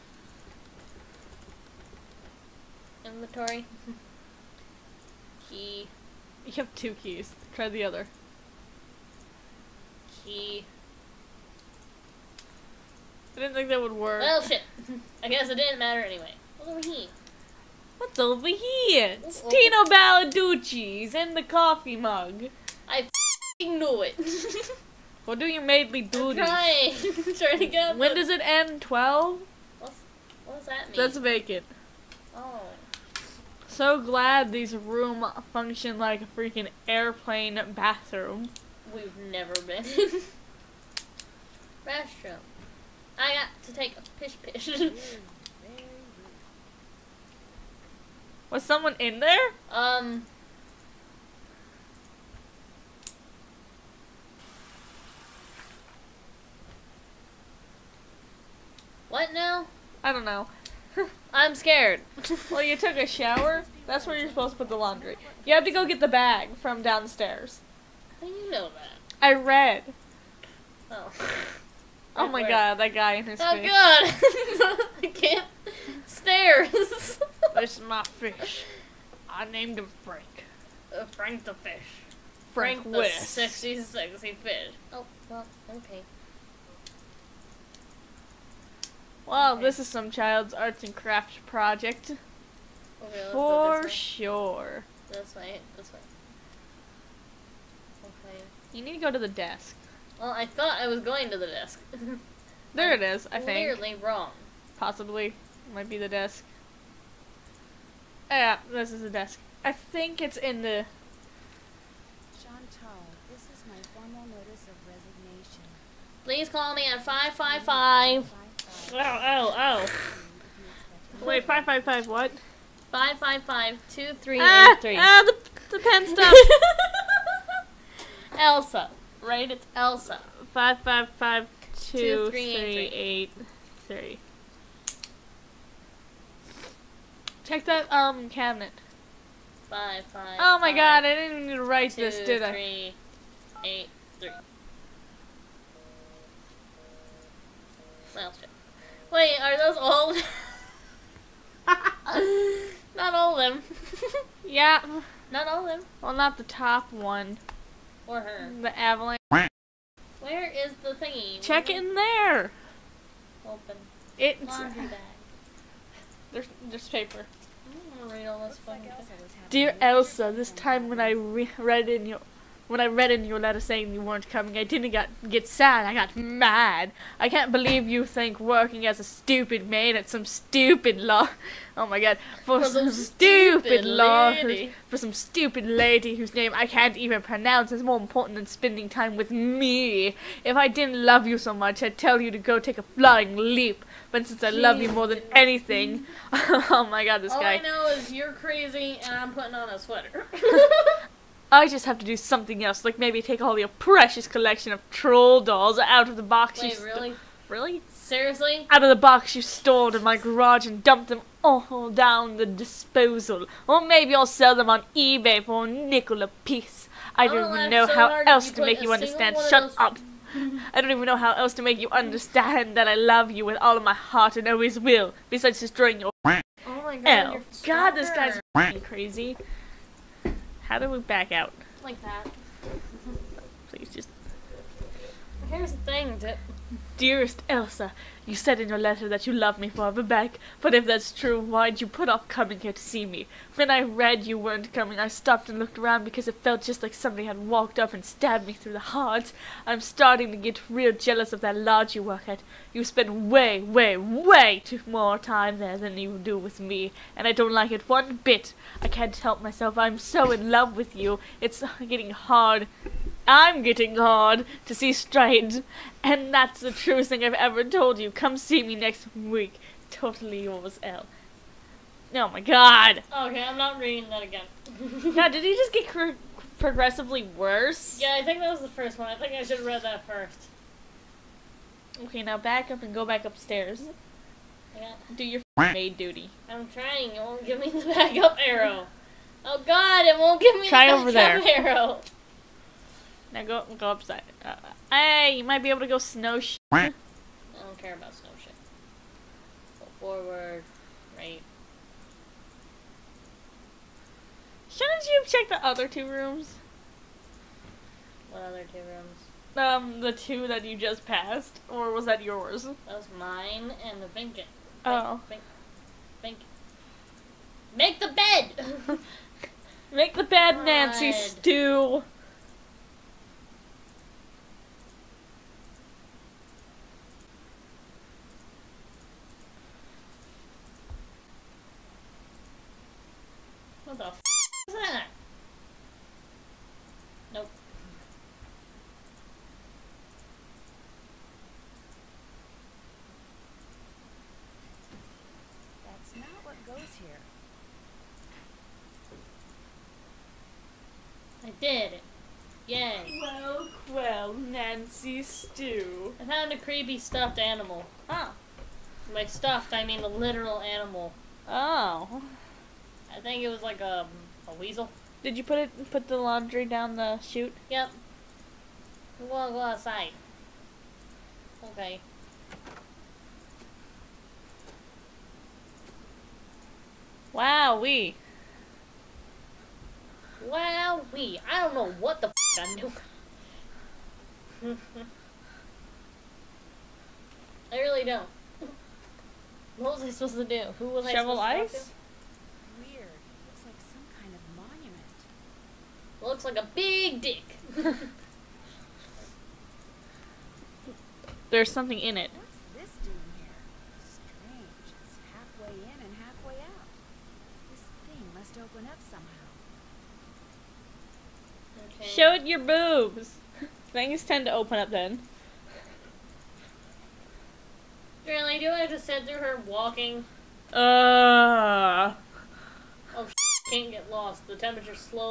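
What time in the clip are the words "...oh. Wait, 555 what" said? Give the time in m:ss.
2:01.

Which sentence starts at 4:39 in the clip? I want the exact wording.
I think I should have read that first.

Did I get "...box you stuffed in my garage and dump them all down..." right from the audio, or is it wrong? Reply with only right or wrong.
wrong.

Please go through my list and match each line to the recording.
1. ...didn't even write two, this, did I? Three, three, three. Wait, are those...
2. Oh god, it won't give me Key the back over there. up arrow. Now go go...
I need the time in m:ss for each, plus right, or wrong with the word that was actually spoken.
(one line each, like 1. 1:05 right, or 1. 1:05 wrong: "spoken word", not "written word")
1. 2:21 wrong: "eight", not "three"
2. 4:49 wrong: "Try", not "Key".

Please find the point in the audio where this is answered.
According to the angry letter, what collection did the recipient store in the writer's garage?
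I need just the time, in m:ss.
3:24.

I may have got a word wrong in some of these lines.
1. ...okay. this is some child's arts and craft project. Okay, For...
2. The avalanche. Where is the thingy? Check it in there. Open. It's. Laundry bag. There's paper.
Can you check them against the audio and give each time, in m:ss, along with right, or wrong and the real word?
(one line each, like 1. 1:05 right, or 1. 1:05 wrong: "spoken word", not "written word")
1. 1:29 right
2. 2:38 right.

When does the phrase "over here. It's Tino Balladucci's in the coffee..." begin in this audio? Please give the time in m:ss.
0:18.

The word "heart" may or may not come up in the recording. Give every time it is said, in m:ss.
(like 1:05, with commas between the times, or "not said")
3:43, 4:08.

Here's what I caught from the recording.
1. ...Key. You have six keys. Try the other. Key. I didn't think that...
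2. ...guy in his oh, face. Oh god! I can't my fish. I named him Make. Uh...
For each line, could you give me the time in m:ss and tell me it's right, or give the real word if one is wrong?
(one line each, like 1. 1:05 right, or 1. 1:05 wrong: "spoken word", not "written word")
1. 0:05 wrong: "two", not "six"
2. 1:12 wrong: "Frank", not "Make".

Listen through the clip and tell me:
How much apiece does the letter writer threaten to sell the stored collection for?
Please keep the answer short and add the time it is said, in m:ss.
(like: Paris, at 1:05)
a nickel, at 3:35.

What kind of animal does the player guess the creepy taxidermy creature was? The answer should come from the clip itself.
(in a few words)
a weasel.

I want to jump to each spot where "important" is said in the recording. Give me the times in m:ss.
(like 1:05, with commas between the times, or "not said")
3:07.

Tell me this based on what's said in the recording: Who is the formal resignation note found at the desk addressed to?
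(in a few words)
Chantal.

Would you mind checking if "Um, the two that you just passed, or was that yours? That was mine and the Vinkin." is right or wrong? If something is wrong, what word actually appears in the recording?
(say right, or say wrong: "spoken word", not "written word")
right.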